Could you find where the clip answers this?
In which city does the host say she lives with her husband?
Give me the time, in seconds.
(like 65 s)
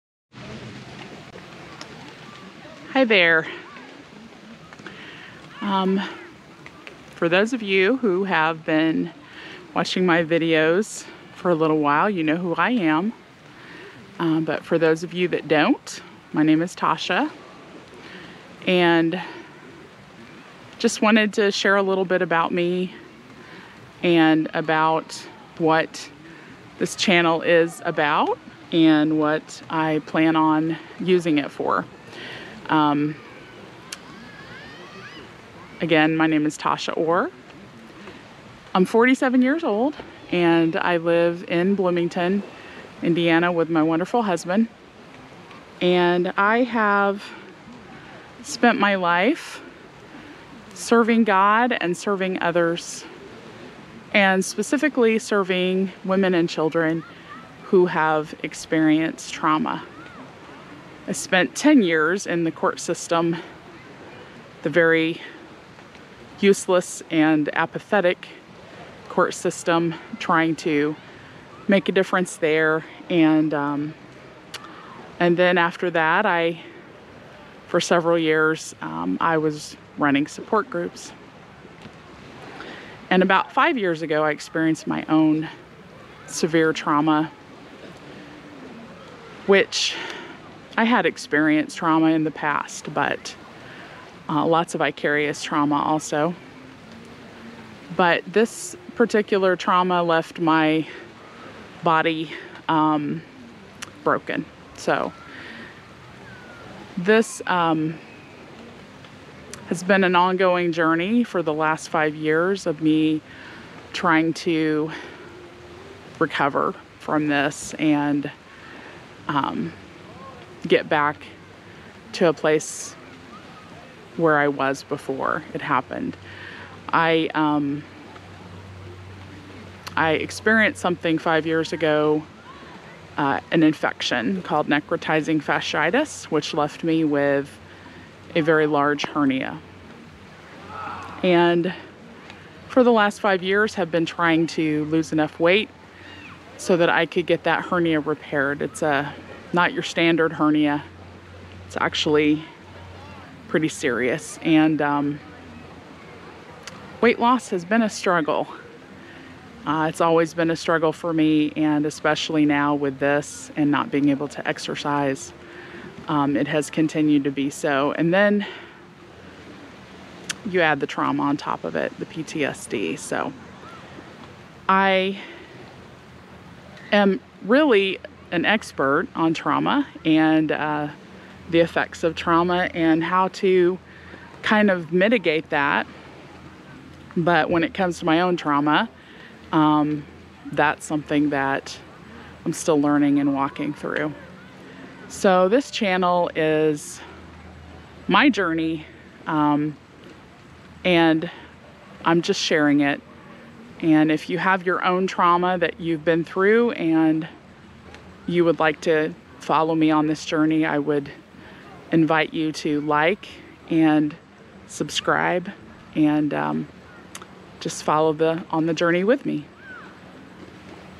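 41 s.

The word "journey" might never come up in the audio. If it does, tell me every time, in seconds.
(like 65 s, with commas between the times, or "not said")
110 s, 198 s, 210 s, 218 s.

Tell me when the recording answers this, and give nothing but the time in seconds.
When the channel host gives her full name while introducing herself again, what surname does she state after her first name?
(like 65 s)
36 s.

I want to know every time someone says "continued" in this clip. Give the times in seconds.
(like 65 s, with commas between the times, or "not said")
166 s.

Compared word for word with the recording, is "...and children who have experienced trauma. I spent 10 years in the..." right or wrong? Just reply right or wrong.
right.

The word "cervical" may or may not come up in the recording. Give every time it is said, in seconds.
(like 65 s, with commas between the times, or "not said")
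not said.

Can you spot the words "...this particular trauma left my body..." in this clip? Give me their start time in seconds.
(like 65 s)
98 s.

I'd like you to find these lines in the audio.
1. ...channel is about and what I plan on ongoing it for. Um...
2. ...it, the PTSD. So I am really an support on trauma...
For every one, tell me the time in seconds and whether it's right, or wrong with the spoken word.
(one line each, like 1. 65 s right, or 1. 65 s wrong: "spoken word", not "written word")
1. 26 s wrong: "using", not "ongoing"
2. 171 s wrong: "expert", not "support".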